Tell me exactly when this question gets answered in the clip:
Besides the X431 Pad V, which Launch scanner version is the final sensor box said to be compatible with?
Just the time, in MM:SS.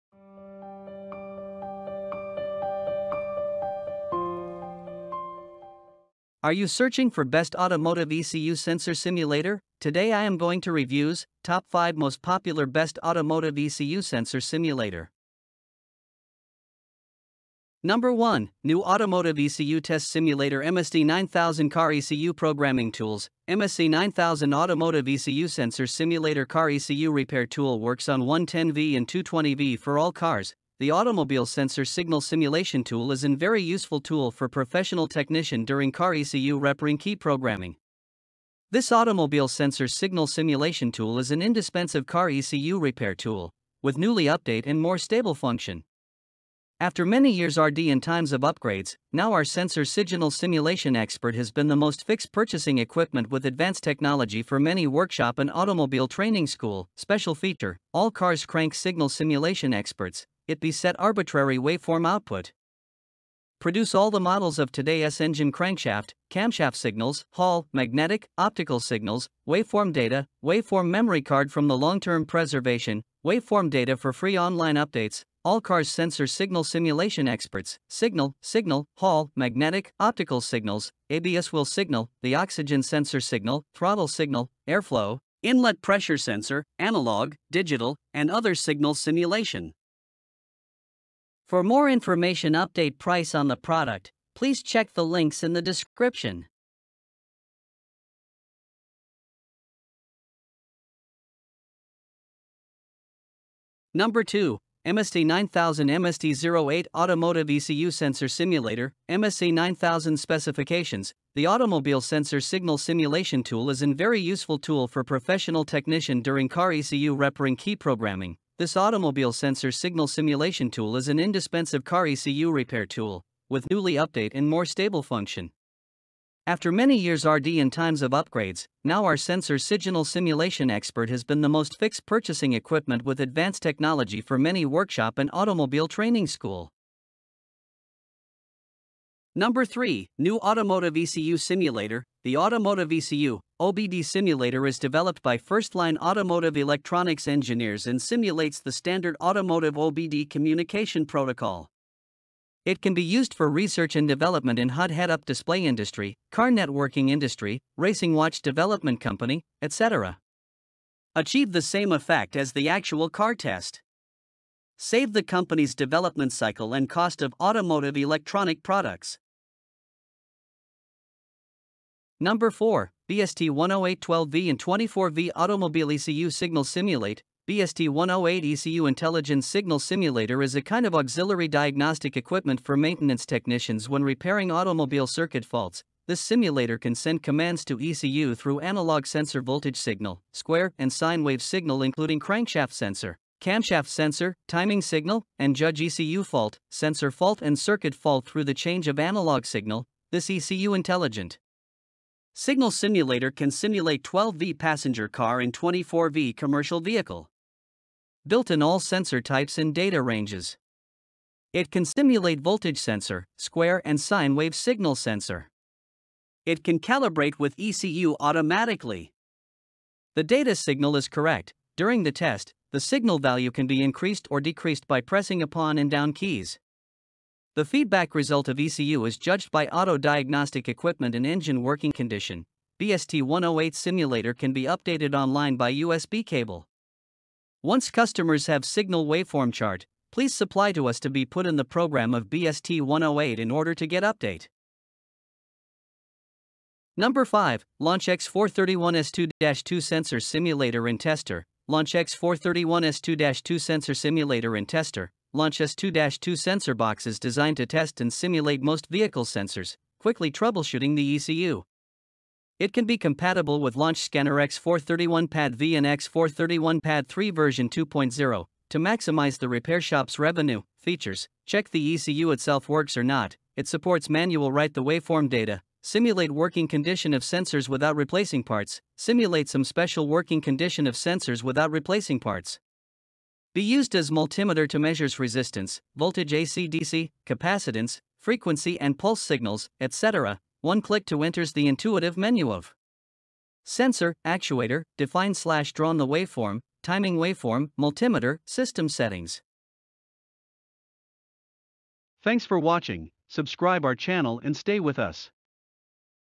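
04:25.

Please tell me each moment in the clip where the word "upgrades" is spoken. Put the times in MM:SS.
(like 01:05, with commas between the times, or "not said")
00:48, 02:08.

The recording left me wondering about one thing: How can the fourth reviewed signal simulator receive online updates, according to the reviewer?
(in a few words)
By USB cable.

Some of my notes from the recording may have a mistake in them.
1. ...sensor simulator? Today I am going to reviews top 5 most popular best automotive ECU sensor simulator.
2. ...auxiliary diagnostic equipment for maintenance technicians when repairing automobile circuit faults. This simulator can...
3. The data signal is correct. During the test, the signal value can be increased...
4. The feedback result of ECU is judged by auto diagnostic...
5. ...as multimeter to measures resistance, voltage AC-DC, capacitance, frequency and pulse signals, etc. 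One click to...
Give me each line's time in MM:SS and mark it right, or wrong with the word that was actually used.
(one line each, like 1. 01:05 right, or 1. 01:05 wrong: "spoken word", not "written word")
1. 00:08 right
2. 03:00 right
3. 03:40 right
4. 03:47 right
5. 04:43 right.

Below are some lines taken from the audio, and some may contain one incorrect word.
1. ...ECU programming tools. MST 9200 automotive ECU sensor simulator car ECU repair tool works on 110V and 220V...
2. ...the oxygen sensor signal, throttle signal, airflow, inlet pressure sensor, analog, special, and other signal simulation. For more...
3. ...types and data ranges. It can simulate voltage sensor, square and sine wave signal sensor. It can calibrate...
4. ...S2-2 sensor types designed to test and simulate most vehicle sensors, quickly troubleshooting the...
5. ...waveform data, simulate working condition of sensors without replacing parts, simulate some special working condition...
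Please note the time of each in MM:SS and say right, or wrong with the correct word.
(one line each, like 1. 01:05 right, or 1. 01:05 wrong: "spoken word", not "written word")
1. 00:21 wrong: "9000", not "9200"
2. 01:22 wrong: "digital", not "special"
3. 03:29 right
4. 04:15 wrong: "boxes", not "types"
5. 04:34 right.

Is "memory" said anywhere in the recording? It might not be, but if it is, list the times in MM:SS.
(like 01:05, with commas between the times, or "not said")
01:10.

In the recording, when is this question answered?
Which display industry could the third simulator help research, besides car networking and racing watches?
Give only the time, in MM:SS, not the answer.
02:34.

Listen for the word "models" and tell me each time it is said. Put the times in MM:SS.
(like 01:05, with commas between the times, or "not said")
01:04.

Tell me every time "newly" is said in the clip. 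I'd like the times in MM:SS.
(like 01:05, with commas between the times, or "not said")
00:43, 02:03.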